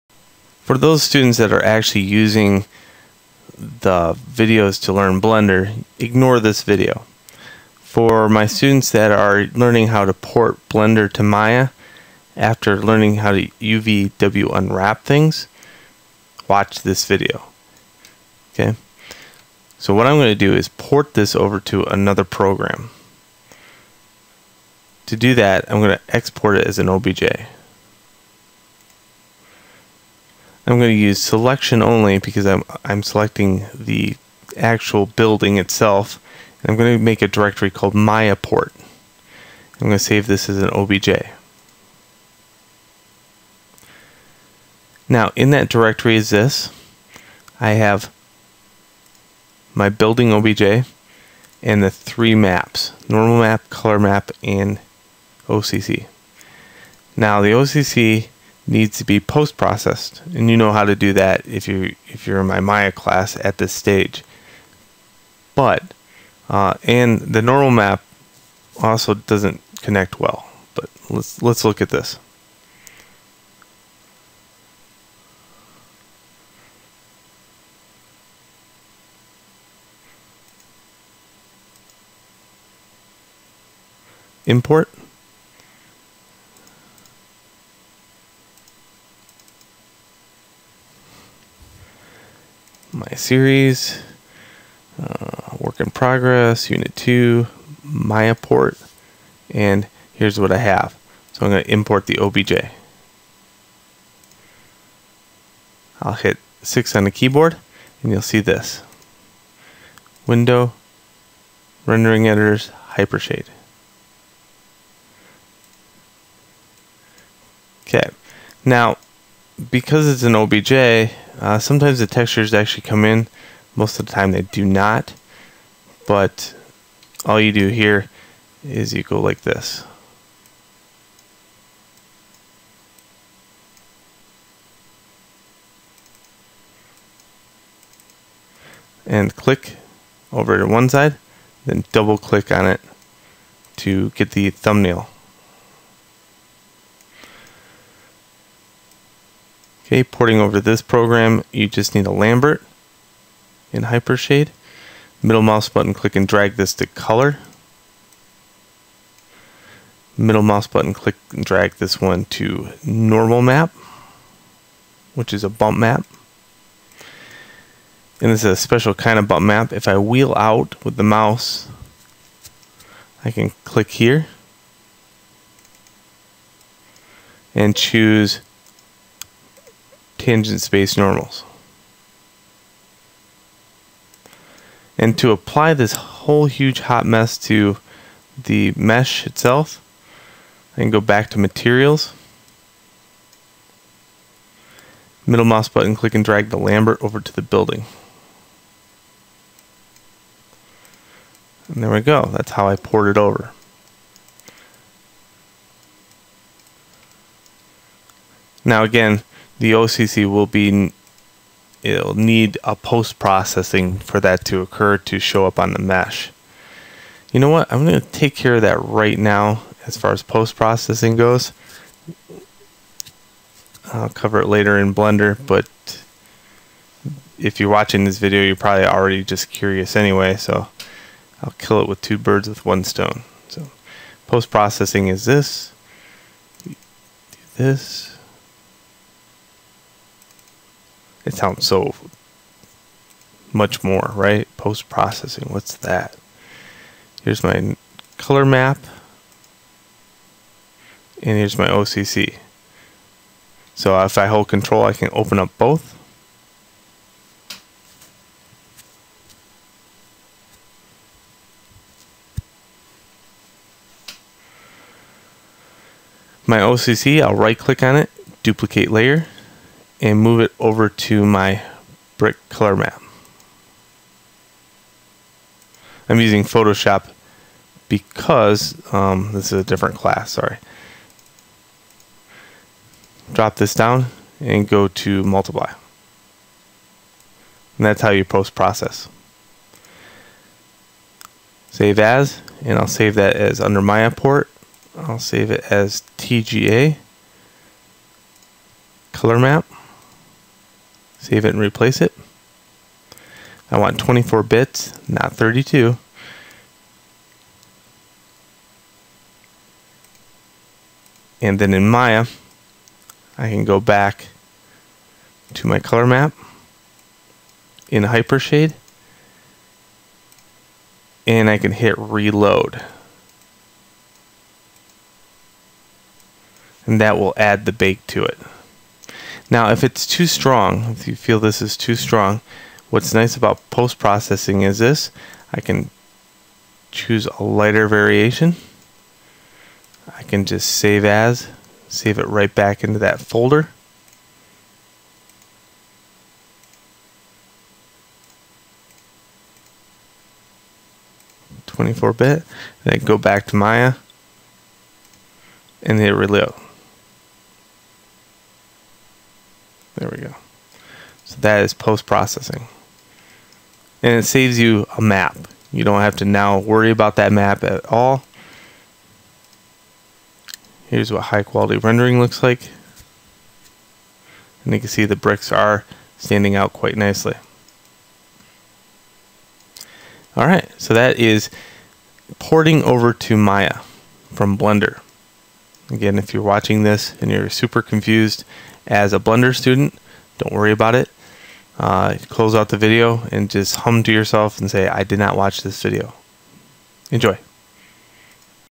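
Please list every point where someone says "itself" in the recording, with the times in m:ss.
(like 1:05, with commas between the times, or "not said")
0:35, 3:09.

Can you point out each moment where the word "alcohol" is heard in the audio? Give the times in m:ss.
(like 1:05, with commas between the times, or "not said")
not said.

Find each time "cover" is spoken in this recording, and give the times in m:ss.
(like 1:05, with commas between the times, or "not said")
3:44.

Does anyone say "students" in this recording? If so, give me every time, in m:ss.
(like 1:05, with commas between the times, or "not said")
0:01, 0:08, 6:29.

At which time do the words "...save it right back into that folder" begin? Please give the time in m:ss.
5:41.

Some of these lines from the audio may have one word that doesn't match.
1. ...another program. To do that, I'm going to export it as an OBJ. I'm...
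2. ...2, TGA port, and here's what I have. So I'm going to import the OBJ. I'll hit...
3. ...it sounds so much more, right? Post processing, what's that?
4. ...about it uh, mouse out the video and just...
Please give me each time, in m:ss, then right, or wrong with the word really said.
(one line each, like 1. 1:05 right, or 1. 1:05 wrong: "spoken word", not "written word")
1. 0:21 right
2. 1:36 wrong: "Maya", not "TGA"
3. 4:01 right
4. 6:30 wrong: "close", not "mouse".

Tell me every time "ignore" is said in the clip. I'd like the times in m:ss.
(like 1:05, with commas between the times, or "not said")
0:05.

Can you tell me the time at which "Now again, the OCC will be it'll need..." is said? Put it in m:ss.
3:28.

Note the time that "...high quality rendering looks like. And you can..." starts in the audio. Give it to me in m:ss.
6:11.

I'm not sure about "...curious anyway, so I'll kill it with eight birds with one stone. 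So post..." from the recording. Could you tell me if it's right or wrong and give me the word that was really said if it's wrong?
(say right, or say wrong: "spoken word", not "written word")
wrong: "two", not "eight".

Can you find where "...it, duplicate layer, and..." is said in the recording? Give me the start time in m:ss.
4:27.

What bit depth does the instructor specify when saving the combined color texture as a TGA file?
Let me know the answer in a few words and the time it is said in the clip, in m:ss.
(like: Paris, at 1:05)
24 bits, at 5:03.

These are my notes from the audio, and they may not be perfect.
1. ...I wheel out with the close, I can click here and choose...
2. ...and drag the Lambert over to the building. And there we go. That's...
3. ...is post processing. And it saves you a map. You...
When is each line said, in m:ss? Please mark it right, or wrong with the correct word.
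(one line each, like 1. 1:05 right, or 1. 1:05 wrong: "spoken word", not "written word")
1. 2:49 wrong: "mouse", not "close"
2. 3:16 right
3. 6:01 right.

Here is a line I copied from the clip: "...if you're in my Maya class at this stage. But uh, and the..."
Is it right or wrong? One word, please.
right.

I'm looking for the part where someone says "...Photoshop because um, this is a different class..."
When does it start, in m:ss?
4:36.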